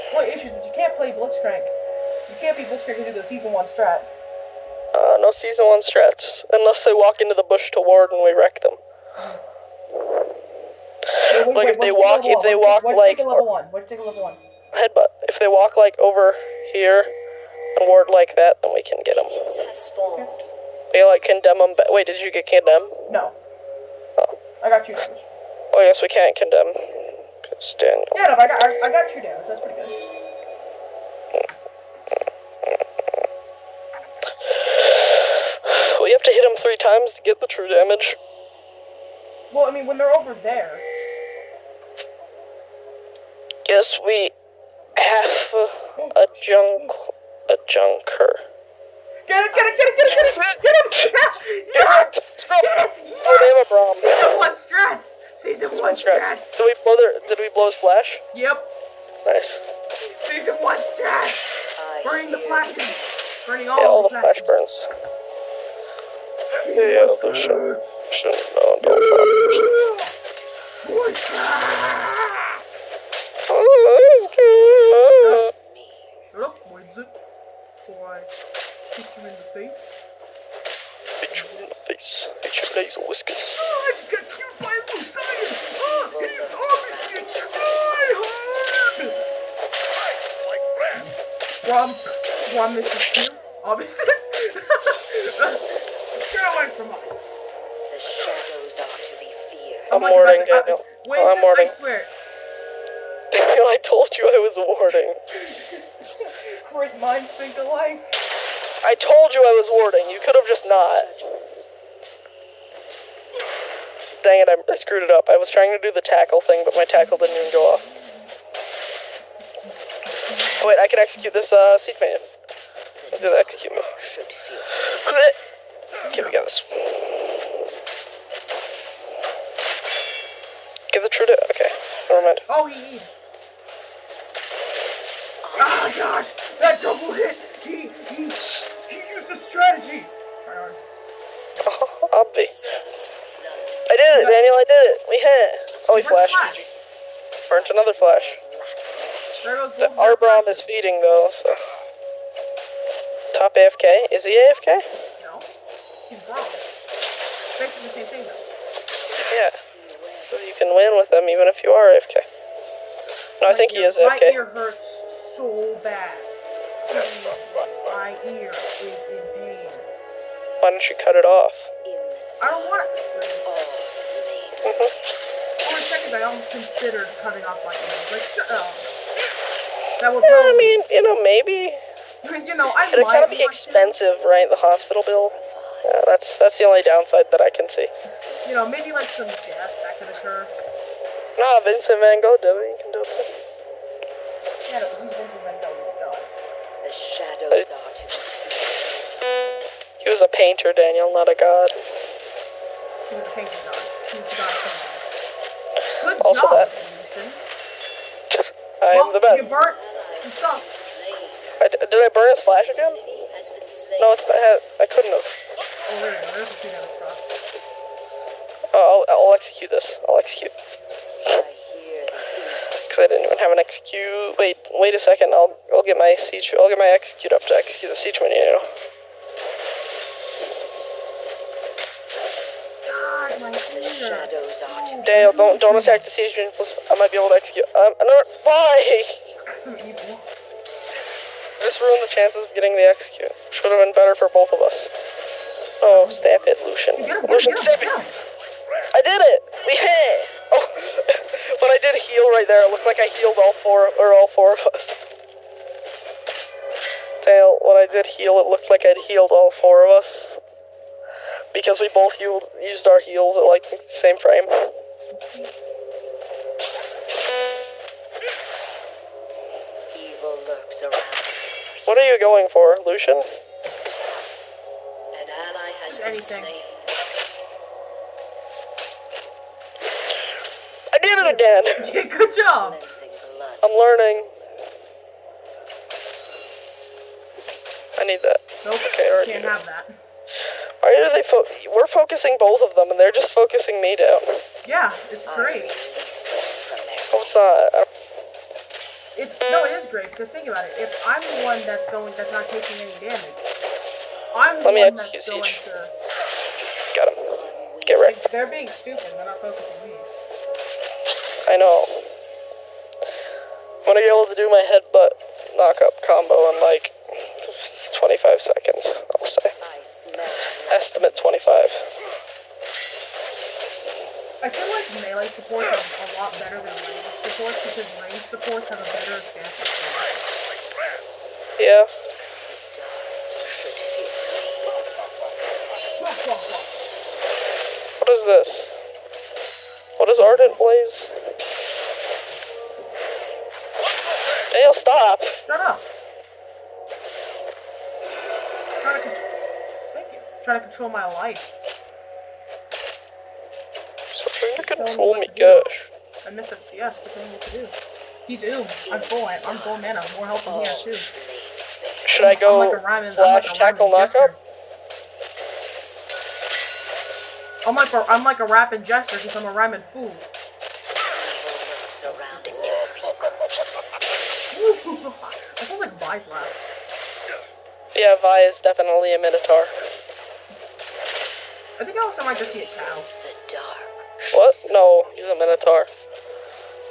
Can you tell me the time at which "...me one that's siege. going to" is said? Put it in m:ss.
5:04.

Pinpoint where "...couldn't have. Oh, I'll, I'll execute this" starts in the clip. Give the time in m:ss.
3:34.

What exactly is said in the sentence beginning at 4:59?
It's no, it is great because think about it.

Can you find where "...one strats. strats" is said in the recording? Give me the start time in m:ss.
0:55.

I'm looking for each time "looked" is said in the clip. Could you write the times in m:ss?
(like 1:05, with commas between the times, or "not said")
4:12, 4:18.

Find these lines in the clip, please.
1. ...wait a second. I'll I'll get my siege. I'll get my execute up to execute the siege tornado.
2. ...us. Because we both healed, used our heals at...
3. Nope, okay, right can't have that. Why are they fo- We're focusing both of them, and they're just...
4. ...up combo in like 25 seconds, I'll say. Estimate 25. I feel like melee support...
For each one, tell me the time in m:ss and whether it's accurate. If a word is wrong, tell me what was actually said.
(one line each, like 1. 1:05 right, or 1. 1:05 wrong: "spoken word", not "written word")
1. 3:44 right
2. 4:19 right
3. 4:48 right
4. 5:15 right.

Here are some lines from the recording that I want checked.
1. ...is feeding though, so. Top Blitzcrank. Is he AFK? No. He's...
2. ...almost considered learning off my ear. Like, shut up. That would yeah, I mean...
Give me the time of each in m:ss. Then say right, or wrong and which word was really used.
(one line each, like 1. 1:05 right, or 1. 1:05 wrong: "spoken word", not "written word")
1. 2:30 wrong: "AFK", not "Blitzcrank"
2. 2:56 wrong: "cutting", not "learning".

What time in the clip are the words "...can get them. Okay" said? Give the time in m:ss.
0:18.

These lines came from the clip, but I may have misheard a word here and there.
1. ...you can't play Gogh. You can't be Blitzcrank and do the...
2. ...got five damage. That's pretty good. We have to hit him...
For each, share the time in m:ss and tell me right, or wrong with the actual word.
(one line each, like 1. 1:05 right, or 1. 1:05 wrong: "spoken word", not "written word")
1. 0:00 wrong: "Blitzcrank", not "Gogh"
2. 0:28 wrong: "two", not "five".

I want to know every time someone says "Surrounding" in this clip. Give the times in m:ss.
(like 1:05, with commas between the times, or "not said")
6:11.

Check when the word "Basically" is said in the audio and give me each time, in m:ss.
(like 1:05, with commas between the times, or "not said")
2:37.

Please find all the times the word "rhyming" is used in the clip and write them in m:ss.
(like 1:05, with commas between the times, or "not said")
6:02, 6:09.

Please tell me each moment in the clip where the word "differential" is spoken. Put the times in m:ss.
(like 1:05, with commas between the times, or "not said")
not said.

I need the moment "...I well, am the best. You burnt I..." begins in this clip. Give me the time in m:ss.
3:28.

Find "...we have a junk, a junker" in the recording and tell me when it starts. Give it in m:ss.
0:44.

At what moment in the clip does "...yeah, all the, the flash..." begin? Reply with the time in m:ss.
1:03.